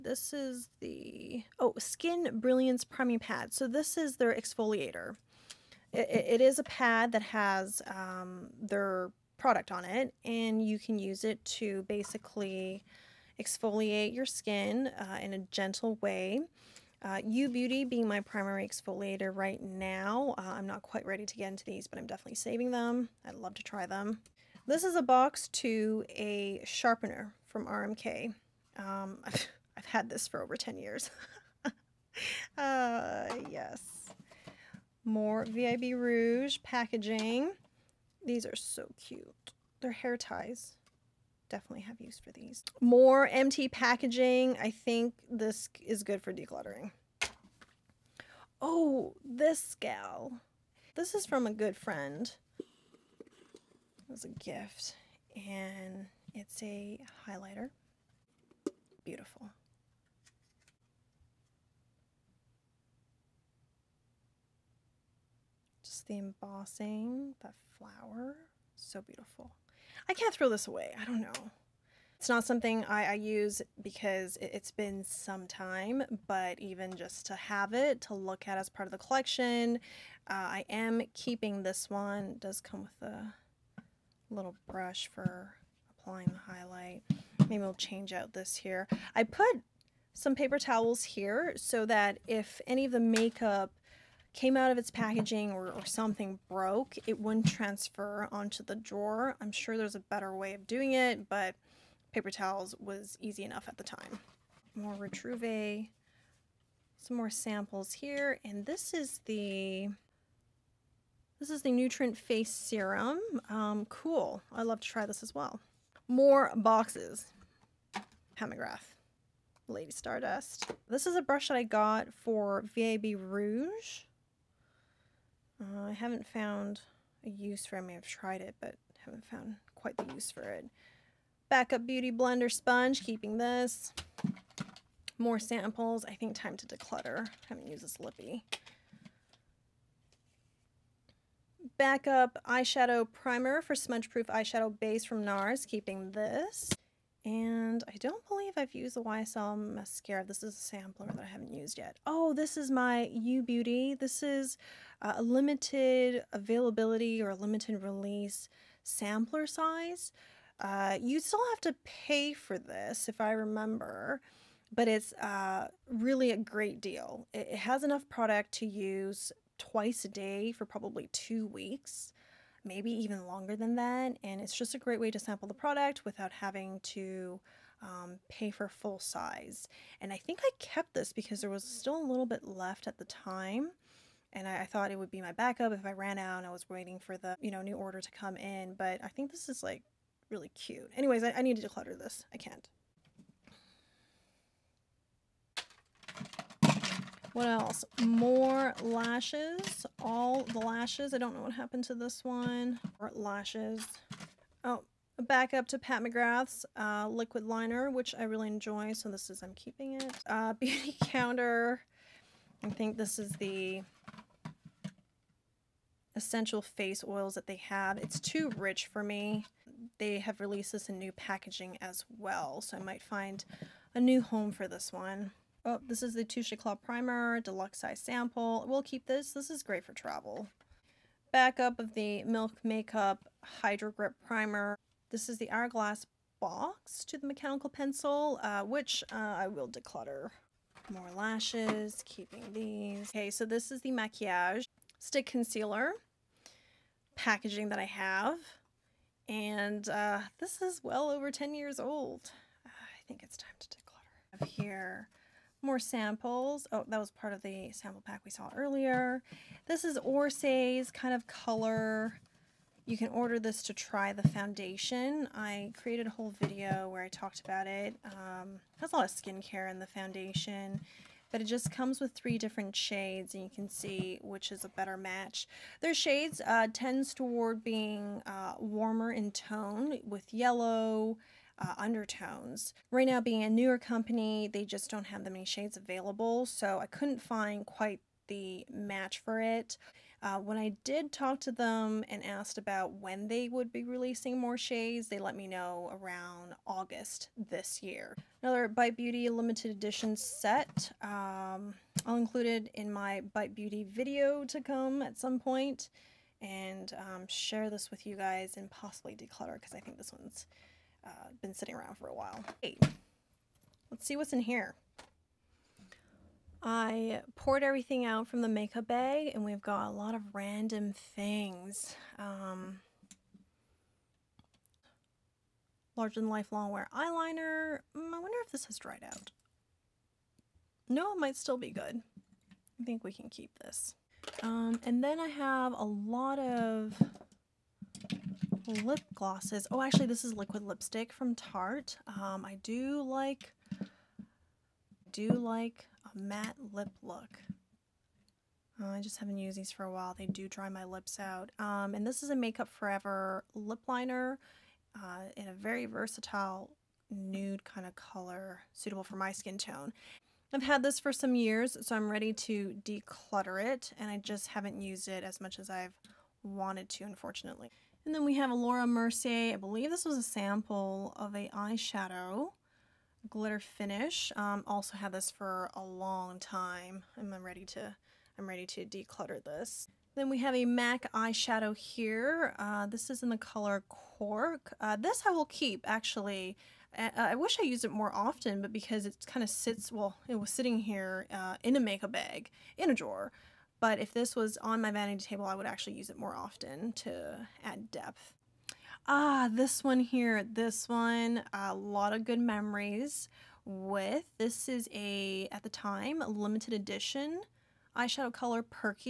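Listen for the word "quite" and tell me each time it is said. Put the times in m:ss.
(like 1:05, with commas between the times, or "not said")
0:20, 2:09, 4:47.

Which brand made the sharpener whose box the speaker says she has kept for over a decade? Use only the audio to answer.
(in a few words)
RMK.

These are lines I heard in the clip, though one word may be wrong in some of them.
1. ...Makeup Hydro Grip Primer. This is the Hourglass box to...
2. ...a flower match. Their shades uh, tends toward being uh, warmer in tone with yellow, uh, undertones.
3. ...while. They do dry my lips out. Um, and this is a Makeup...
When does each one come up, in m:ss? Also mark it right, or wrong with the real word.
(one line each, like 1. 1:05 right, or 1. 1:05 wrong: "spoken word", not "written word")
1. 3:52 right
2. 4:34 wrong: "better", not "flower"
3. 5:49 right.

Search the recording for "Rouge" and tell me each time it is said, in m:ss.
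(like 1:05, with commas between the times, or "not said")
0:35, 2:03.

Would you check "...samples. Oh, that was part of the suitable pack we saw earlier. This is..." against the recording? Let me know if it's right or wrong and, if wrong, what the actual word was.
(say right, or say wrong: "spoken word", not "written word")
wrong: "sample", not "suitable".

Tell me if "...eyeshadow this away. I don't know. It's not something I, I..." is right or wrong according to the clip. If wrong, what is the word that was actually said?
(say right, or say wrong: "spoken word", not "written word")
wrong: "throw", not "eyeshadow".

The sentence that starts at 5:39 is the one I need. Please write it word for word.
Oh, actually, this is liquid lipstick from Tarte.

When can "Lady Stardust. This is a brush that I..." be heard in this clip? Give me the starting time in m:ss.
1:59.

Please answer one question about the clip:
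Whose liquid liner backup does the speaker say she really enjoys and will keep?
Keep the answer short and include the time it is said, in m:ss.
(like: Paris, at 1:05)
Pat McGrath, at 3:25.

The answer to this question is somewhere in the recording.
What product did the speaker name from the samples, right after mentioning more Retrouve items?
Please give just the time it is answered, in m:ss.
1:51.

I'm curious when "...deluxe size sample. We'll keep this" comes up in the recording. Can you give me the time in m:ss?
3:47.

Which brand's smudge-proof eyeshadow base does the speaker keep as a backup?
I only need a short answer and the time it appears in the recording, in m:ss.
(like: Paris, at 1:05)
NARS, at 2:25.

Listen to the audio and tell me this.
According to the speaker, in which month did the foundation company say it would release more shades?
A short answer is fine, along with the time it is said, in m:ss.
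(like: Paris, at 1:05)
August, at 4:56.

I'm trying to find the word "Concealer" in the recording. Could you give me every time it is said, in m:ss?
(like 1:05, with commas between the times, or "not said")
4:05.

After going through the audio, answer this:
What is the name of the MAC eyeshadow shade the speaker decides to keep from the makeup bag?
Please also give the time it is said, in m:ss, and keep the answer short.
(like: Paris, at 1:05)
Cork, at 6:23.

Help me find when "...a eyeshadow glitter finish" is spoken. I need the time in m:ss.
6:11.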